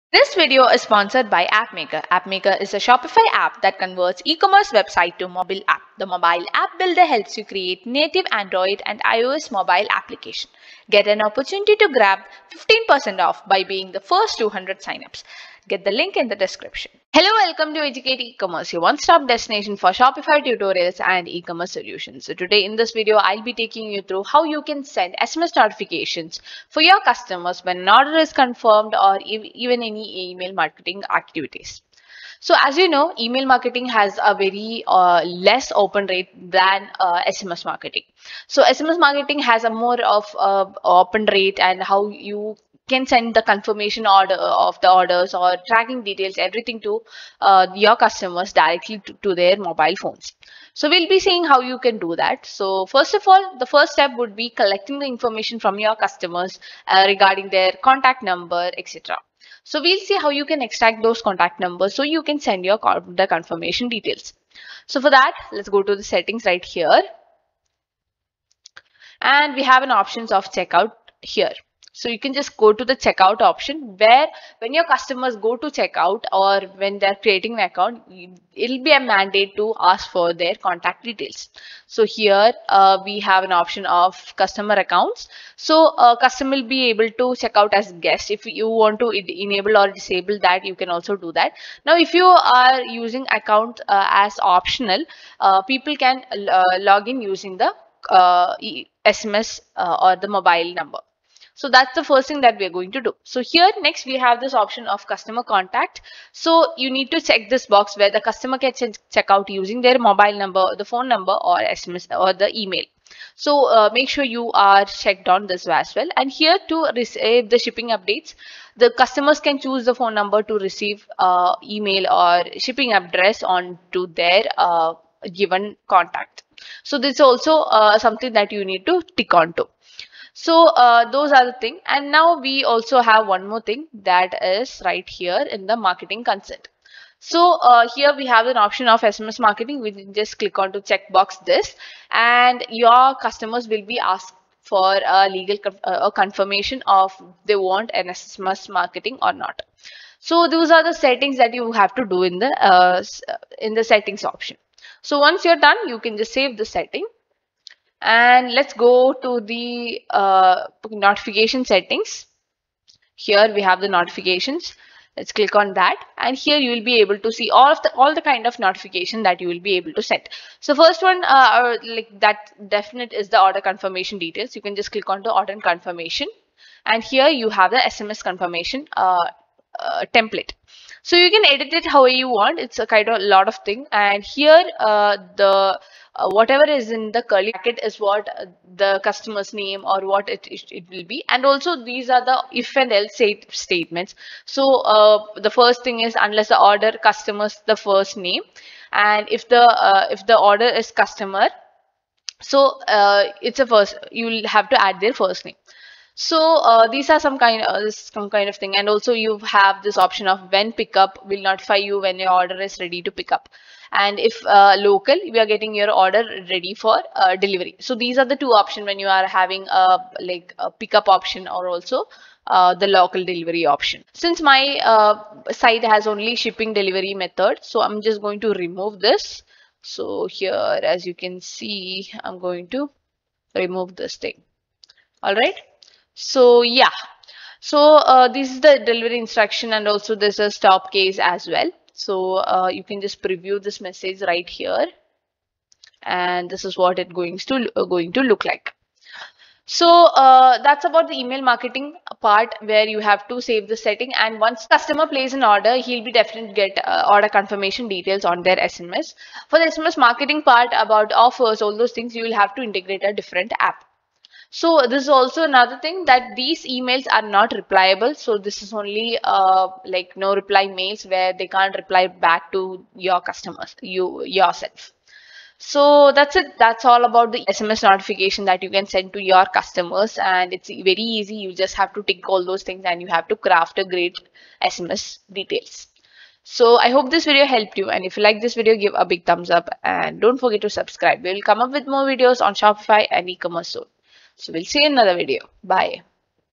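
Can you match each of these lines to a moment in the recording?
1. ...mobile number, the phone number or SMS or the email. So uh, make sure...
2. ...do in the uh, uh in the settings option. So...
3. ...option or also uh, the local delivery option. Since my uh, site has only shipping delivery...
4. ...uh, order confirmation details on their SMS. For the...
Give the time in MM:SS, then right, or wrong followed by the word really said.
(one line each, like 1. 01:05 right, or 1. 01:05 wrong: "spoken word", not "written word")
1. 01:49 right
2. 02:32 right
3. 03:41 right
4. 04:16 right.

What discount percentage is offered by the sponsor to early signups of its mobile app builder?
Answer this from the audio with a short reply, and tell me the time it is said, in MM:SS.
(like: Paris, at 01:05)
15%, at 00:12.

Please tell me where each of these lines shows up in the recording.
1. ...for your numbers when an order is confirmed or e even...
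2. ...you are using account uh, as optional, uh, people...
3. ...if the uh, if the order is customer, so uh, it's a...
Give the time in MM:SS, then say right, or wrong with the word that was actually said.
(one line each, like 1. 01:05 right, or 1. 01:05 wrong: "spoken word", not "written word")
1. 00:26 wrong: "customers", not "numbers"
2. 01:32 right
3. 03:19 right.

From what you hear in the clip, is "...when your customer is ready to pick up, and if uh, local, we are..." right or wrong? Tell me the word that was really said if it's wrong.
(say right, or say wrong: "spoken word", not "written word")
wrong: "order", not "customer".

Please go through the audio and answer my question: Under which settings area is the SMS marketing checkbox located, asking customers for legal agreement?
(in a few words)
Marketing consent.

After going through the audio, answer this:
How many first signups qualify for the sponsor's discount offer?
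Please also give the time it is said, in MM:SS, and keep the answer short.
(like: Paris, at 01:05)
200, at 00:14.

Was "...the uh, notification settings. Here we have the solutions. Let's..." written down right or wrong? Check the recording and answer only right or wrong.
wrong.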